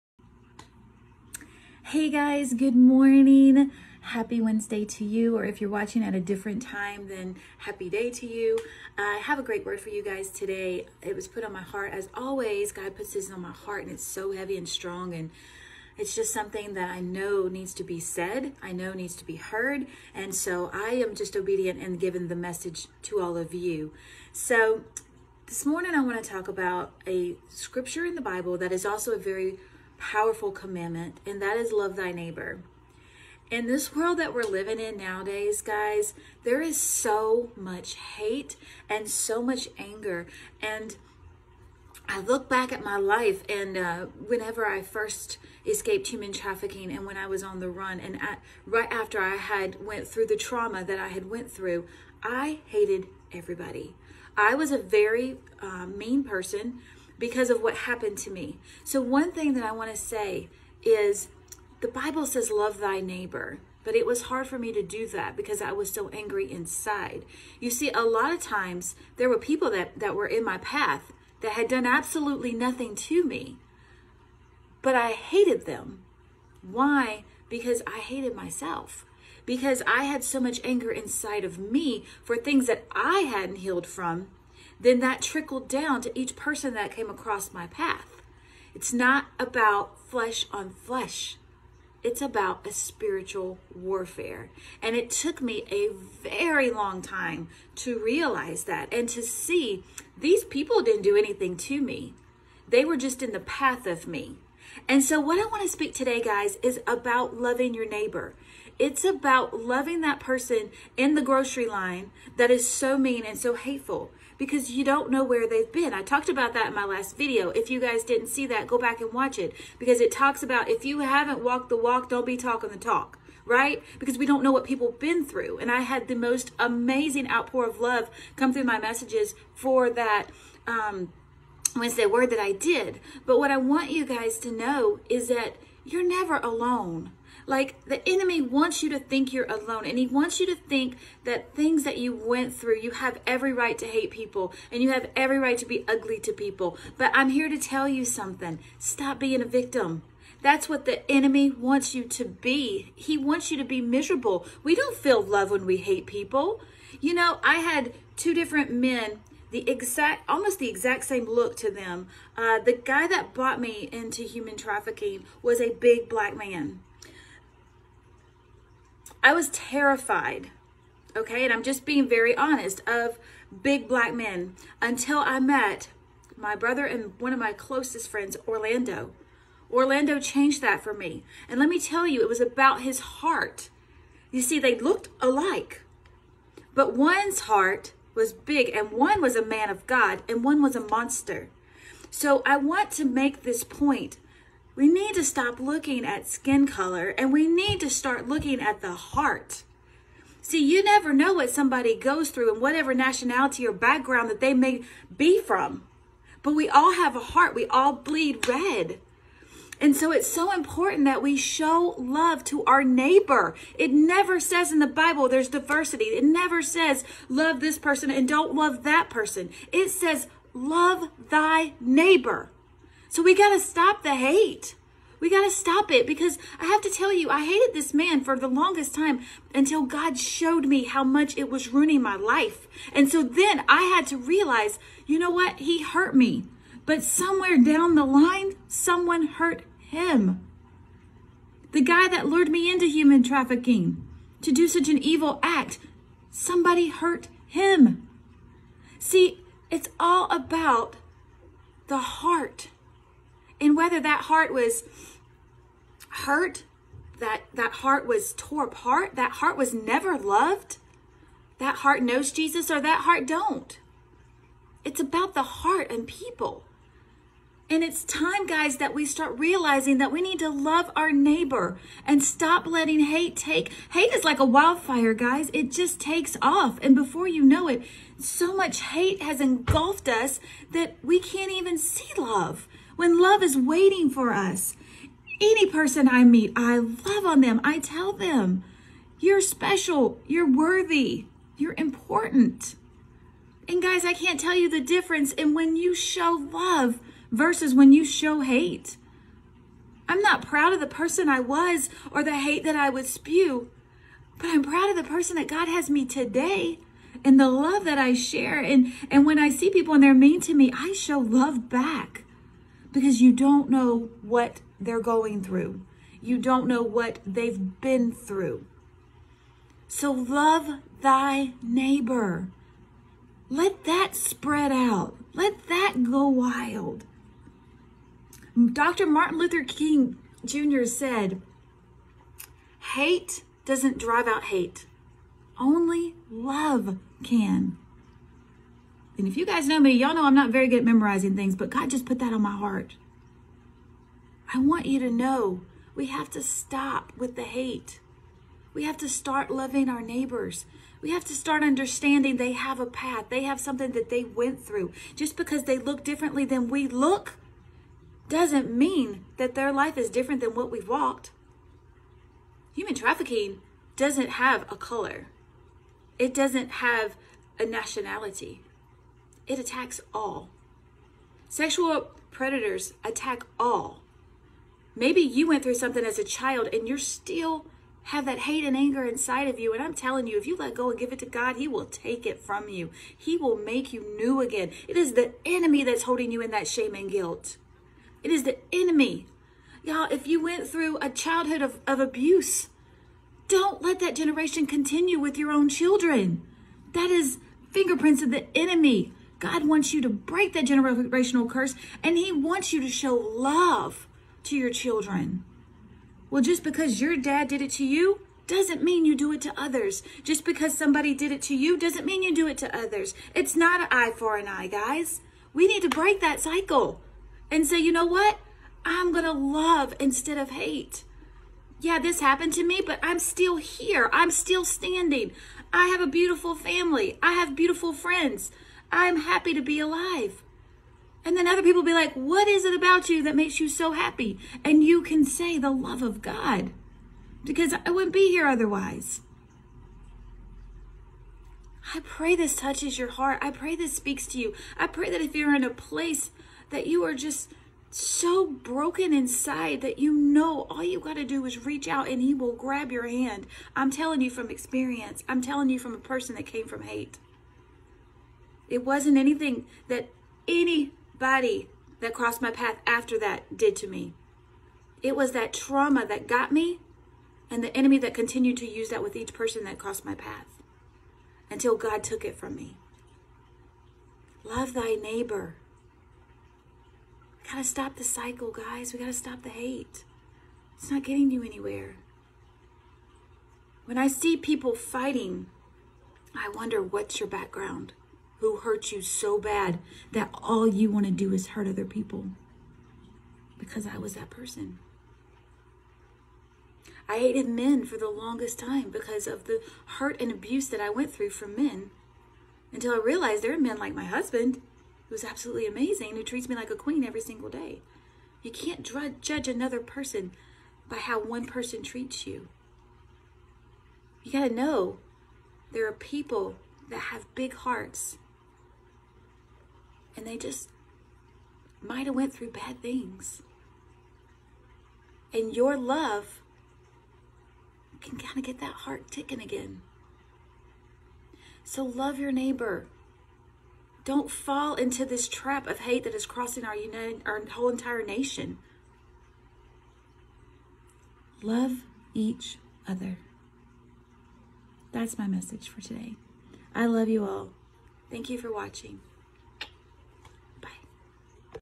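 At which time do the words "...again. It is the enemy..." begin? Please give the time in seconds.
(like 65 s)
384 s.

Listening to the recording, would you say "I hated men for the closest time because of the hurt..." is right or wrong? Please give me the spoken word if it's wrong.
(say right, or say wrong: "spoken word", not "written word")
wrong: "longest", not "closest".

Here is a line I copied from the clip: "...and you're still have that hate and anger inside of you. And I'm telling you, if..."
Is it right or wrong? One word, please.
right.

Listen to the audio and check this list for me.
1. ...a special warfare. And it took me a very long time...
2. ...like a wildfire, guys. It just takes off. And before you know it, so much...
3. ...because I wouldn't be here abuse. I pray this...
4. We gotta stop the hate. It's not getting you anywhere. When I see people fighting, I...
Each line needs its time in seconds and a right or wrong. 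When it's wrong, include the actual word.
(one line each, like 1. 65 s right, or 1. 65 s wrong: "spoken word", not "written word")
1. 92 s wrong: "spiritual", not "special"
2. 274 s right
3. 437 s wrong: "otherwise", not "abuse"
4. 478 s right.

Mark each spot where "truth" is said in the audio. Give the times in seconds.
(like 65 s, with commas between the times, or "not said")
not said.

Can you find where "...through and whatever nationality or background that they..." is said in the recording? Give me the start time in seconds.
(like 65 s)
202 s.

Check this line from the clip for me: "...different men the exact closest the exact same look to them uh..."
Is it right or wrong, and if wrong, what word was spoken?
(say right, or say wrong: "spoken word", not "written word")
wrong: "almost", not "closest".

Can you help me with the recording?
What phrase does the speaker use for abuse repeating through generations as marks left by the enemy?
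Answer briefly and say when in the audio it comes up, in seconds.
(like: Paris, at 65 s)
fingerprints of the enemy, at 397 s.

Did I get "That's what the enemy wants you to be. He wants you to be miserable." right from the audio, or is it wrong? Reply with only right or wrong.
right.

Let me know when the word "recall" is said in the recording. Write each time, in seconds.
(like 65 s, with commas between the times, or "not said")
not said.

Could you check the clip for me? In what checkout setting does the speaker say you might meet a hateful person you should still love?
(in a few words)
grocery line.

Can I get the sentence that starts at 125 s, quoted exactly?
And I had the most amazing outpour of love come through my messages for that um, Wednesday word that I did.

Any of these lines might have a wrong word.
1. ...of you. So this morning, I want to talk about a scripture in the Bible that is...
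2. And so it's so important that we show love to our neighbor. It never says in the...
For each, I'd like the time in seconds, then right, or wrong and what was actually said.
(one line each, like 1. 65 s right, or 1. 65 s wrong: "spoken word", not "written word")
1. 23 s right
2. 209 s right.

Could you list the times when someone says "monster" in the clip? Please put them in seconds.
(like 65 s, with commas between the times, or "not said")
190 s.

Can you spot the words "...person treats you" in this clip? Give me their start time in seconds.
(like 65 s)
511 s.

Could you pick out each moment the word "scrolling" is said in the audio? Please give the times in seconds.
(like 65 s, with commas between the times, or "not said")
not said.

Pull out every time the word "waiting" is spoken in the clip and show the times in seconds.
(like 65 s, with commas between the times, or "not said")
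283 s.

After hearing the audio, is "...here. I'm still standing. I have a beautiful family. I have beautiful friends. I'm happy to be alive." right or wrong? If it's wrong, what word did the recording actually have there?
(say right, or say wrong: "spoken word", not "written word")
right.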